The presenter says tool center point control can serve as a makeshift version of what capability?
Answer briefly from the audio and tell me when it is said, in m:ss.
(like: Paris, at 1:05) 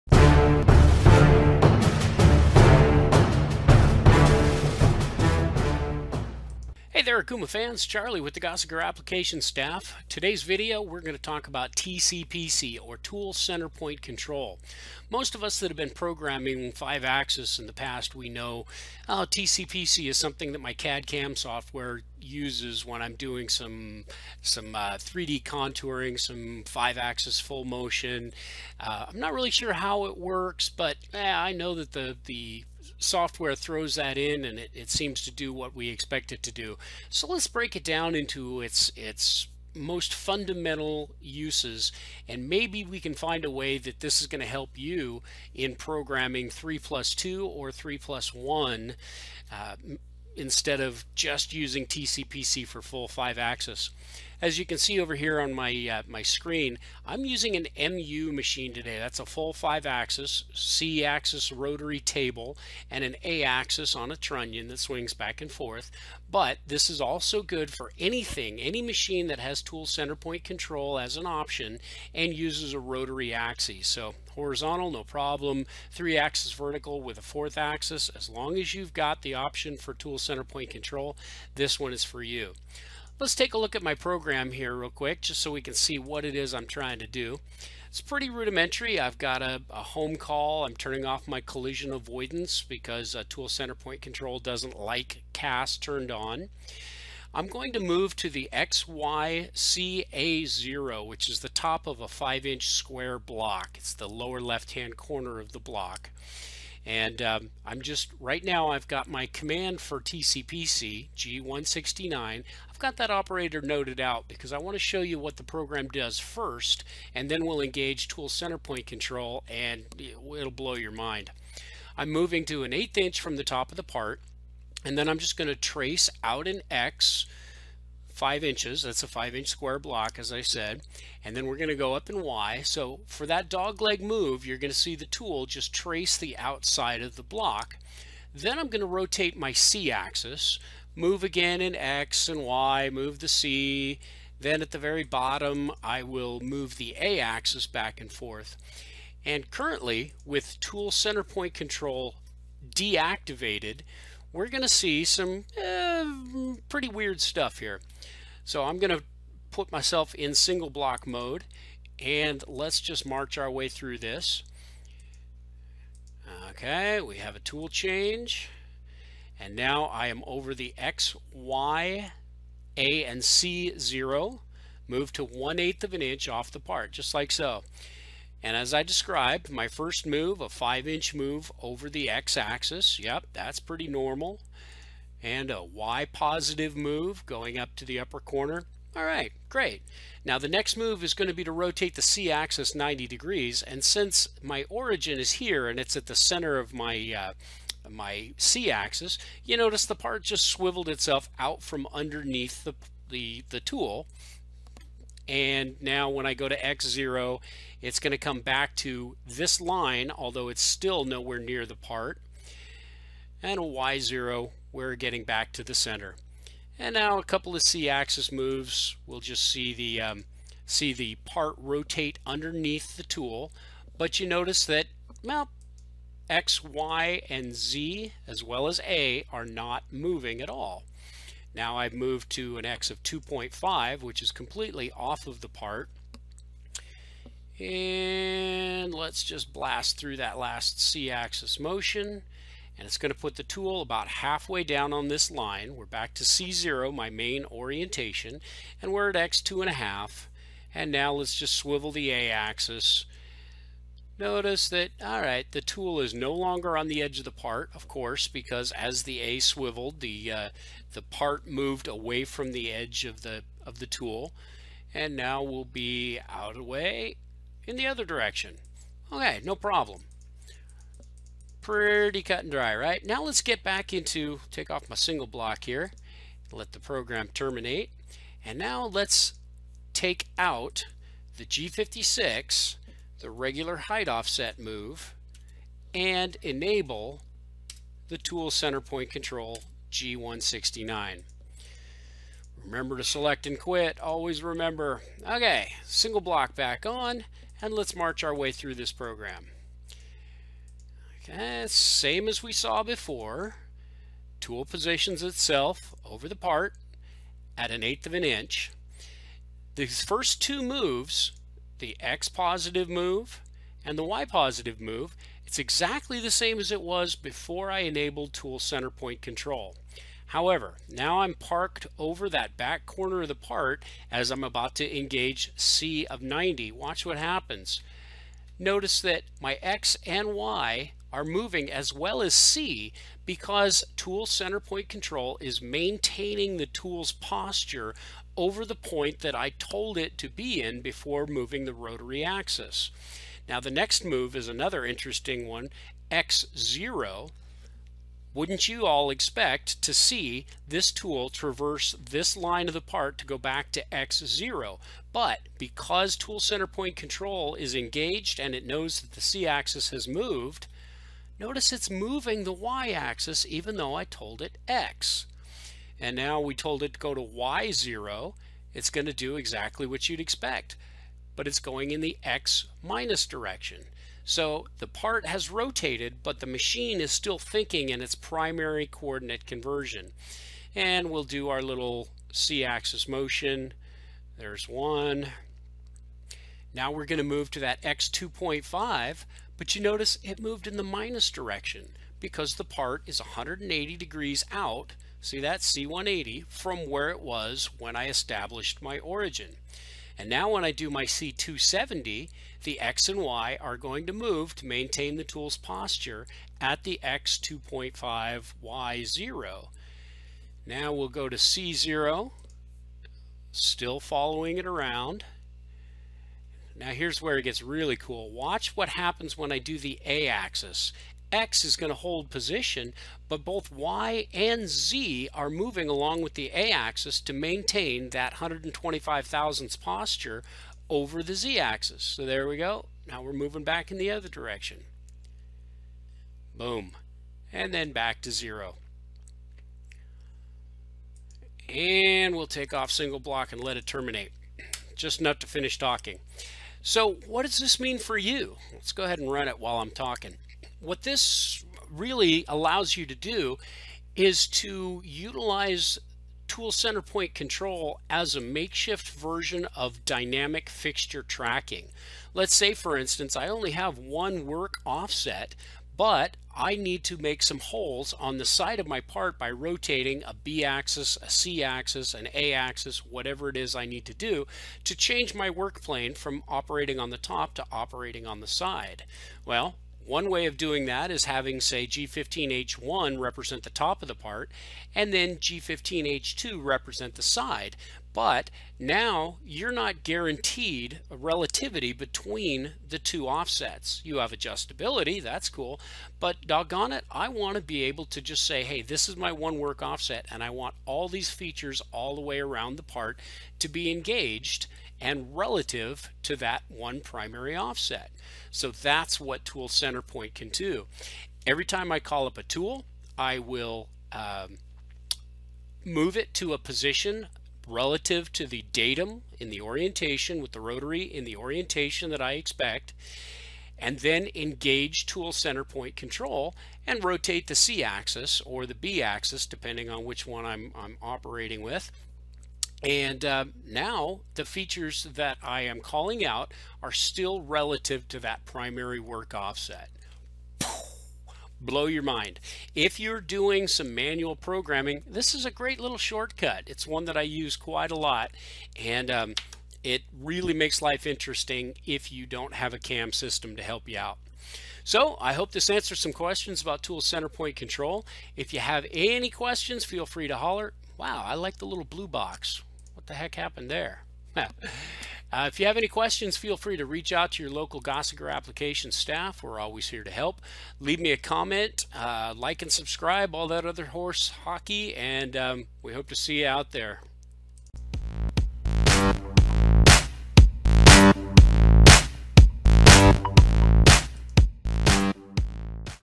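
Dynamic fixture tracking, at 7:40.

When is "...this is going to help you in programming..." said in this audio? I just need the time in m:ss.
0:44.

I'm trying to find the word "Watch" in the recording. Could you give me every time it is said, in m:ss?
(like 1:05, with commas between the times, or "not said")
5:26, 6:58.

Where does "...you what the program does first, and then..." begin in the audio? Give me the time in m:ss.
1:55.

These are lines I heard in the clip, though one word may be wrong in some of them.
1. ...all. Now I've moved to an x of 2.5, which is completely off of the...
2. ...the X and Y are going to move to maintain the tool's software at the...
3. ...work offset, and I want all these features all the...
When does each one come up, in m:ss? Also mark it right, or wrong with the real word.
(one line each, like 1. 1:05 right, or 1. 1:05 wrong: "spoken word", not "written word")
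1. 3:50 right
2. 6:42 wrong: "posture", not "software"
3. 8:19 right.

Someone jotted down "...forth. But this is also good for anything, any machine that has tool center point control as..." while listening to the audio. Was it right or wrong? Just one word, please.
right.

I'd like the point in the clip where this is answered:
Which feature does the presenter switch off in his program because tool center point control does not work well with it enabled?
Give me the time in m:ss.
1:31.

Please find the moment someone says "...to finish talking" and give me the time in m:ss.
7:25.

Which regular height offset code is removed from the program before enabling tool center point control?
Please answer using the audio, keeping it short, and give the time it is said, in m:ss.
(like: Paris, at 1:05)
G56, at 4:41.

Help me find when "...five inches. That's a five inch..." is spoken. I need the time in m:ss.
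2:08.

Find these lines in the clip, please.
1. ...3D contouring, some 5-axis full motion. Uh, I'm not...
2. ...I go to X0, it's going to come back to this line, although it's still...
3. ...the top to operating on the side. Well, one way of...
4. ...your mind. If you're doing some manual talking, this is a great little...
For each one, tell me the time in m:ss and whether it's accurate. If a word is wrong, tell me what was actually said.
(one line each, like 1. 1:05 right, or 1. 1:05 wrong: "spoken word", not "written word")
1. 0:24 right
2. 3:26 right
3. 7:57 right
4. 9:01 wrong: "programming", not "talking".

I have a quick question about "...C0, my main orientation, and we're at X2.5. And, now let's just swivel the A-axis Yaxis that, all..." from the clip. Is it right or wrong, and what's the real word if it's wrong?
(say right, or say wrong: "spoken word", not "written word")
wrong: "Notice", not "Yaxis".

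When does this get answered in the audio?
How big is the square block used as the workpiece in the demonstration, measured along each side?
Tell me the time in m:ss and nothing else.
1:42.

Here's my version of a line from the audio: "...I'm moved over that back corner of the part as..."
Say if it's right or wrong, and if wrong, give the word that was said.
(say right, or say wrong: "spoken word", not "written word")
wrong: "parked", not "moved".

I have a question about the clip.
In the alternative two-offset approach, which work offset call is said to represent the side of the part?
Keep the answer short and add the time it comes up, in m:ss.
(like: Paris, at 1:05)
G15H2, at 8:05.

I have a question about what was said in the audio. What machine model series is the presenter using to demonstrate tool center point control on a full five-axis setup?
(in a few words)
MU.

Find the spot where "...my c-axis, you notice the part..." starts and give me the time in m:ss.
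3:17.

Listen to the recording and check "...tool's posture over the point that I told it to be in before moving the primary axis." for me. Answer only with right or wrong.
wrong.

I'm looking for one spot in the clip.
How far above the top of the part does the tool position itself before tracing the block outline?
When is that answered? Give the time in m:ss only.
2:55.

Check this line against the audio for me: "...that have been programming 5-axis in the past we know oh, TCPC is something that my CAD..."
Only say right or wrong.
right.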